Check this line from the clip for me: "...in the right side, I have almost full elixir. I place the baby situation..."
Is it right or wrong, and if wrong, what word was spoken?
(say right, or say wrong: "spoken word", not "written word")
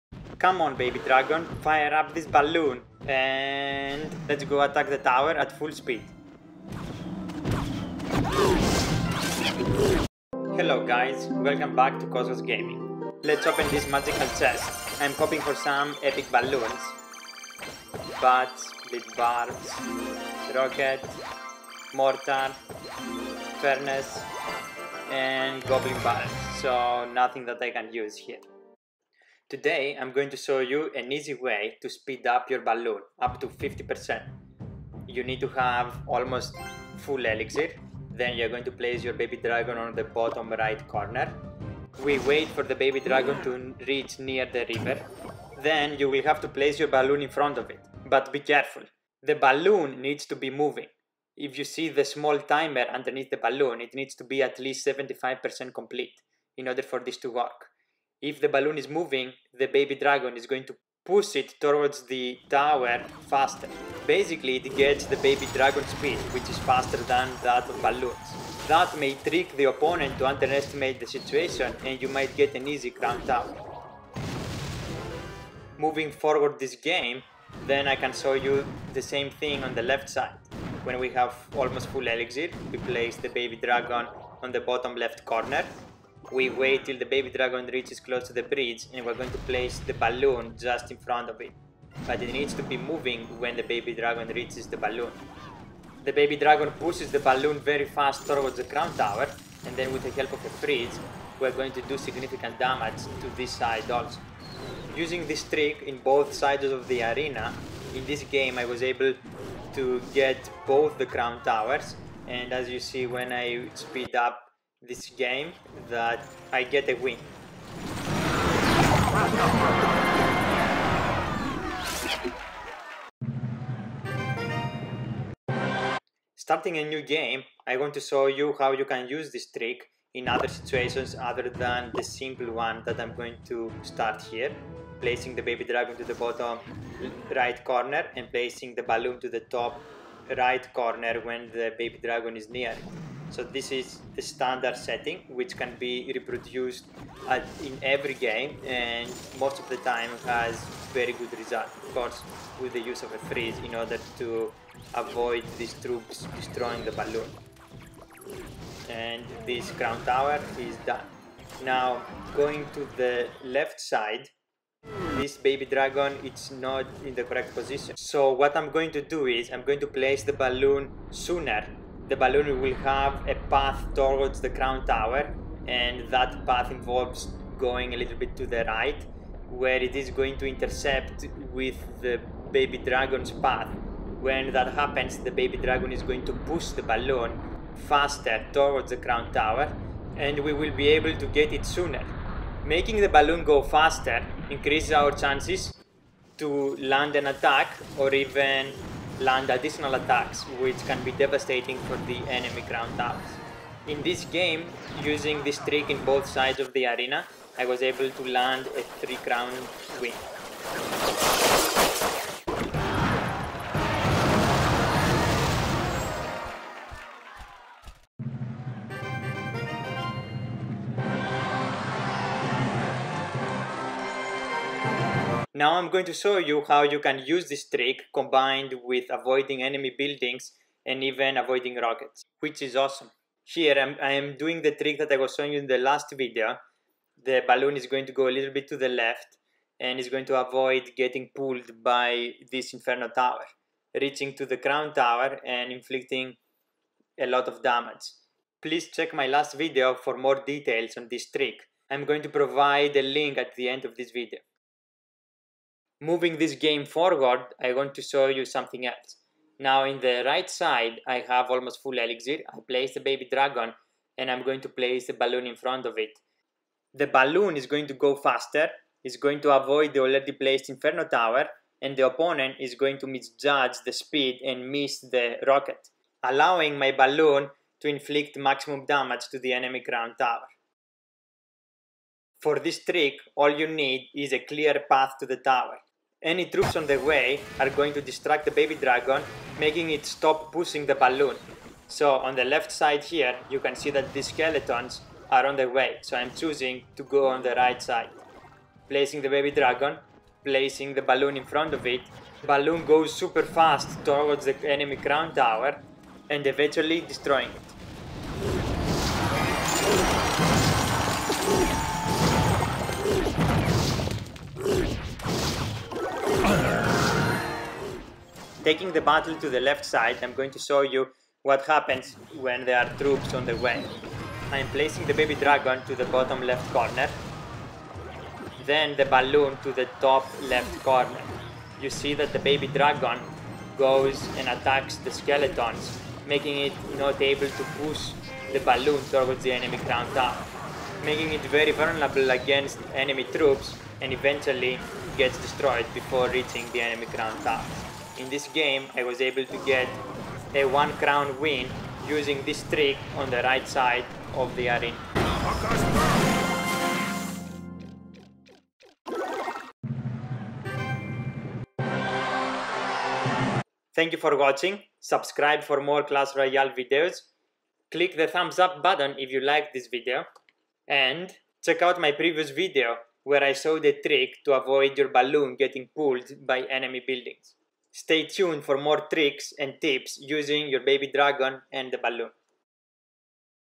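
wrong: "dragon", not "situation".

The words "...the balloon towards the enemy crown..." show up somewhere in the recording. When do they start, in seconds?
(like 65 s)
338 s.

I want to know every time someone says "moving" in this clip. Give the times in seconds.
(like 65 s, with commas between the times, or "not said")
50 s, 58 s, 75 s, 92 s, 256 s.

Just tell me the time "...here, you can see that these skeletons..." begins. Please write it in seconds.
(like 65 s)
293 s.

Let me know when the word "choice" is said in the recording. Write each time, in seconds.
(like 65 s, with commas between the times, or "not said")
not said.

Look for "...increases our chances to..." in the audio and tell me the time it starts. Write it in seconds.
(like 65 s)
194 s.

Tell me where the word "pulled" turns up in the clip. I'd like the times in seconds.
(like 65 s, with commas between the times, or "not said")
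241 s, 375 s.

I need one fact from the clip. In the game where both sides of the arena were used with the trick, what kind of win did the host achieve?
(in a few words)
3 crown win.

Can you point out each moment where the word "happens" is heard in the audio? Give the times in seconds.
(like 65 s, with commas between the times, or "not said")
184 s, 321 s.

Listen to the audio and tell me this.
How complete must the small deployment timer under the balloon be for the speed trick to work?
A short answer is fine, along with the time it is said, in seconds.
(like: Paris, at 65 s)
75%, at 54 s.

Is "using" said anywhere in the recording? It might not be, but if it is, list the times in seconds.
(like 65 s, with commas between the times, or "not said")
104 s, 205 s, 352 s, 380 s.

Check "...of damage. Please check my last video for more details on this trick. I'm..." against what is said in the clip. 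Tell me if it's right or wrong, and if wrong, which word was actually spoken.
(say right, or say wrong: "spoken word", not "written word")
right.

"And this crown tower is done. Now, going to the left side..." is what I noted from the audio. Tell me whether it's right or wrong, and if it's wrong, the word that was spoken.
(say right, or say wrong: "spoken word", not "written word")
right.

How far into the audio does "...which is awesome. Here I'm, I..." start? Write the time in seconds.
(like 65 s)
232 s.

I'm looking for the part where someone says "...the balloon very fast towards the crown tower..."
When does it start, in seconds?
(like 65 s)
97 s.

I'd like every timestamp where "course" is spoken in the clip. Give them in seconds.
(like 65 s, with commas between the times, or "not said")
151 s.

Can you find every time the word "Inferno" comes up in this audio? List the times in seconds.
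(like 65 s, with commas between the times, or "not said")
242 s, 270 s.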